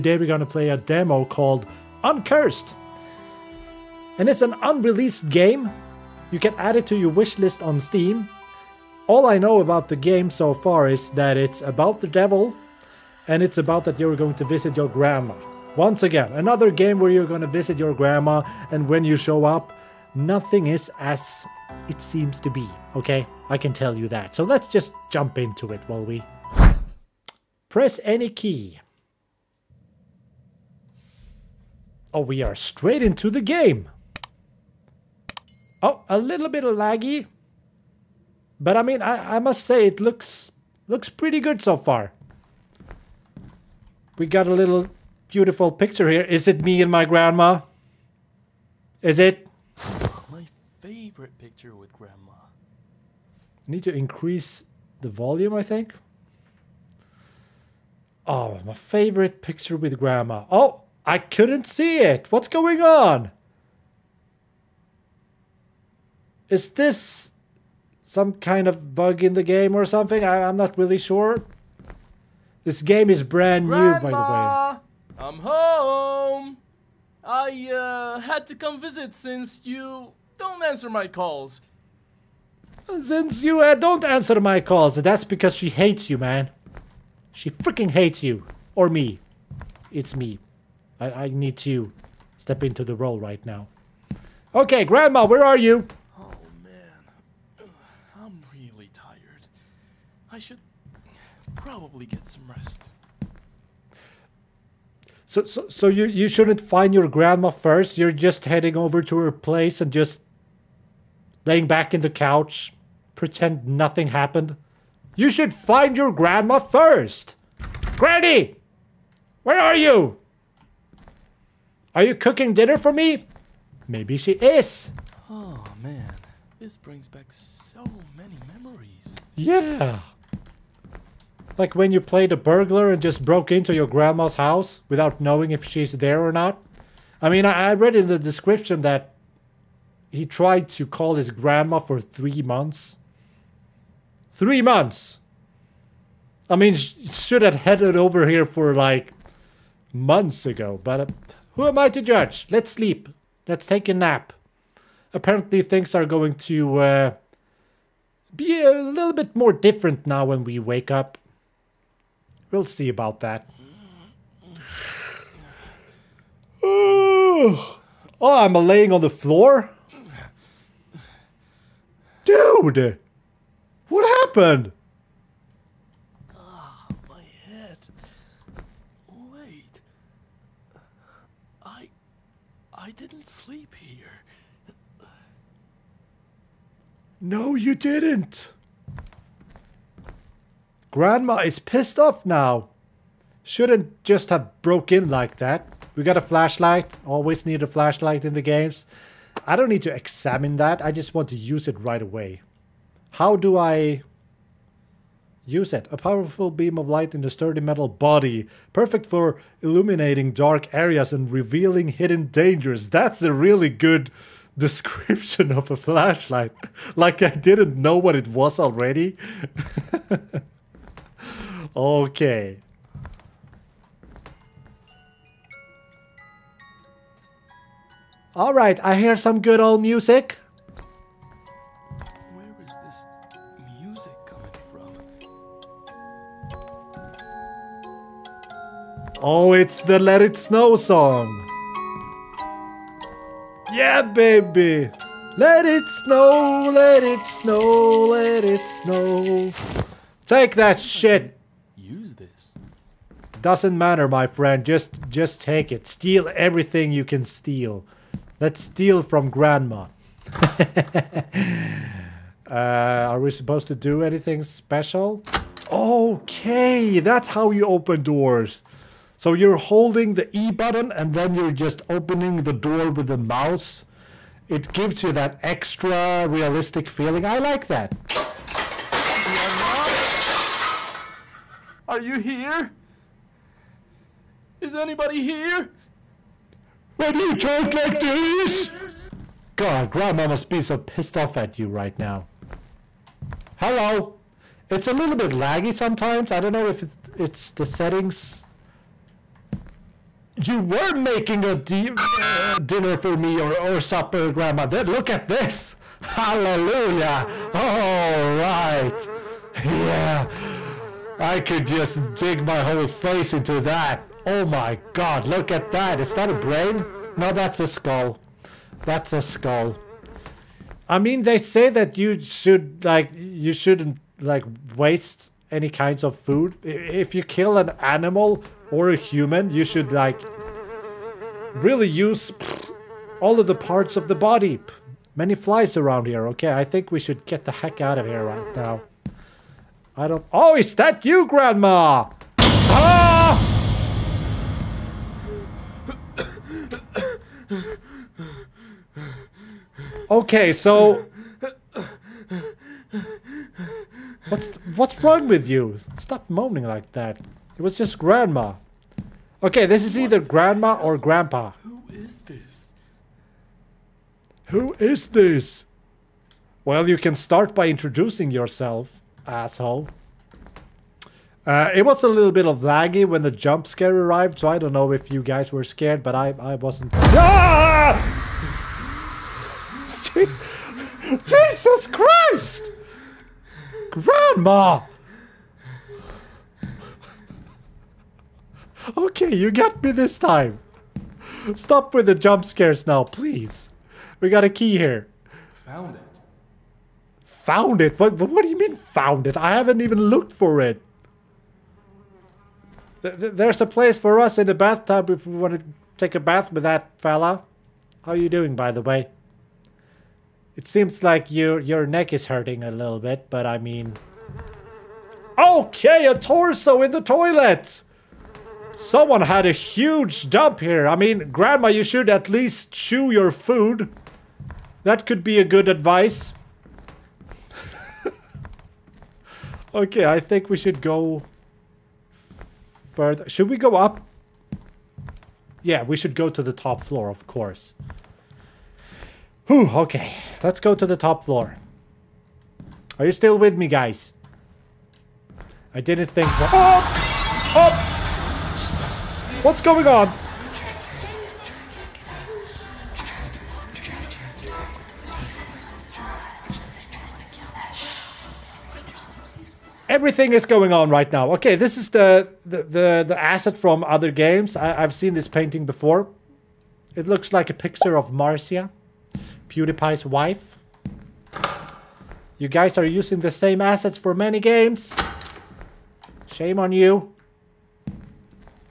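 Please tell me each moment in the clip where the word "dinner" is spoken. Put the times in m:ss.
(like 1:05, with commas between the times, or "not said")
2:02, 5:02.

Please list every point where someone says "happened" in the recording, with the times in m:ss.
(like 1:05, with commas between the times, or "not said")
1:54, 2:54.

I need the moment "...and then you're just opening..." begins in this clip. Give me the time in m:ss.
4:30.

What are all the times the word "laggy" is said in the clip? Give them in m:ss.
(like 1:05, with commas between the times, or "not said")
0:36, 4:55, 6:12.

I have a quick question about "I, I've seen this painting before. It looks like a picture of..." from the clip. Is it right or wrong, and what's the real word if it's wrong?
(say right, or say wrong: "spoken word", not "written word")
right.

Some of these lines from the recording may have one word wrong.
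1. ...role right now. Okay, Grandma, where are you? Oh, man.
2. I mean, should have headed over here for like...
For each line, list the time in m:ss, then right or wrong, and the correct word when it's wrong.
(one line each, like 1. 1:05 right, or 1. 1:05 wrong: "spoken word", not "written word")
1. 1:32 right
2. 2:26 right.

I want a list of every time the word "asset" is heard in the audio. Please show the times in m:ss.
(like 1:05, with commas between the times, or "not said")
7:43, 7:53.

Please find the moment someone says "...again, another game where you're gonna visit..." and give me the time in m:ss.
0:16.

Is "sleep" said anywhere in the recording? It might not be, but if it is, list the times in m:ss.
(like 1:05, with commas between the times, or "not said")
2:32, 3:03.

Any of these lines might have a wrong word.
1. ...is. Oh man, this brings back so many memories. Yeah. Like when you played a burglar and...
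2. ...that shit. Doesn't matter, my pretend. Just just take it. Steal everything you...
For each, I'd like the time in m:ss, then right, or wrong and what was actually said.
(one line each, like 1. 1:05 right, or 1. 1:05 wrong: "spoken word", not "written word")
1. 2:04 right
2. 4:10 wrong: "friend", not "pretend".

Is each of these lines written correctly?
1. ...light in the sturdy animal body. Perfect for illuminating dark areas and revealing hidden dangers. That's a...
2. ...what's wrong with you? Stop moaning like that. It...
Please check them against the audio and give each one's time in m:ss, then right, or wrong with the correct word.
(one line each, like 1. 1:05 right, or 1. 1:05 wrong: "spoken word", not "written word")
1. 3:26 wrong: "metal", not "animal"
2. 5:54 right.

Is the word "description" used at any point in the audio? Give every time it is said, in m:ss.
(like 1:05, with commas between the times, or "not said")
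2:18, 3:34.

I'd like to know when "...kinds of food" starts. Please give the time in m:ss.
5:25.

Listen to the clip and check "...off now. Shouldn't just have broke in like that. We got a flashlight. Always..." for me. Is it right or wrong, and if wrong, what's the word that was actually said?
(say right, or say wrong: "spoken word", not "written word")
right.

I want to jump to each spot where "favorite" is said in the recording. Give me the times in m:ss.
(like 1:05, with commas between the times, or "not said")
0:50, 0:58.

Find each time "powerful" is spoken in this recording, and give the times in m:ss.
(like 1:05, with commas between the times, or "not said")
3:25.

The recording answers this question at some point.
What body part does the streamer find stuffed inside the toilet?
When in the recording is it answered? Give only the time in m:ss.
6:56.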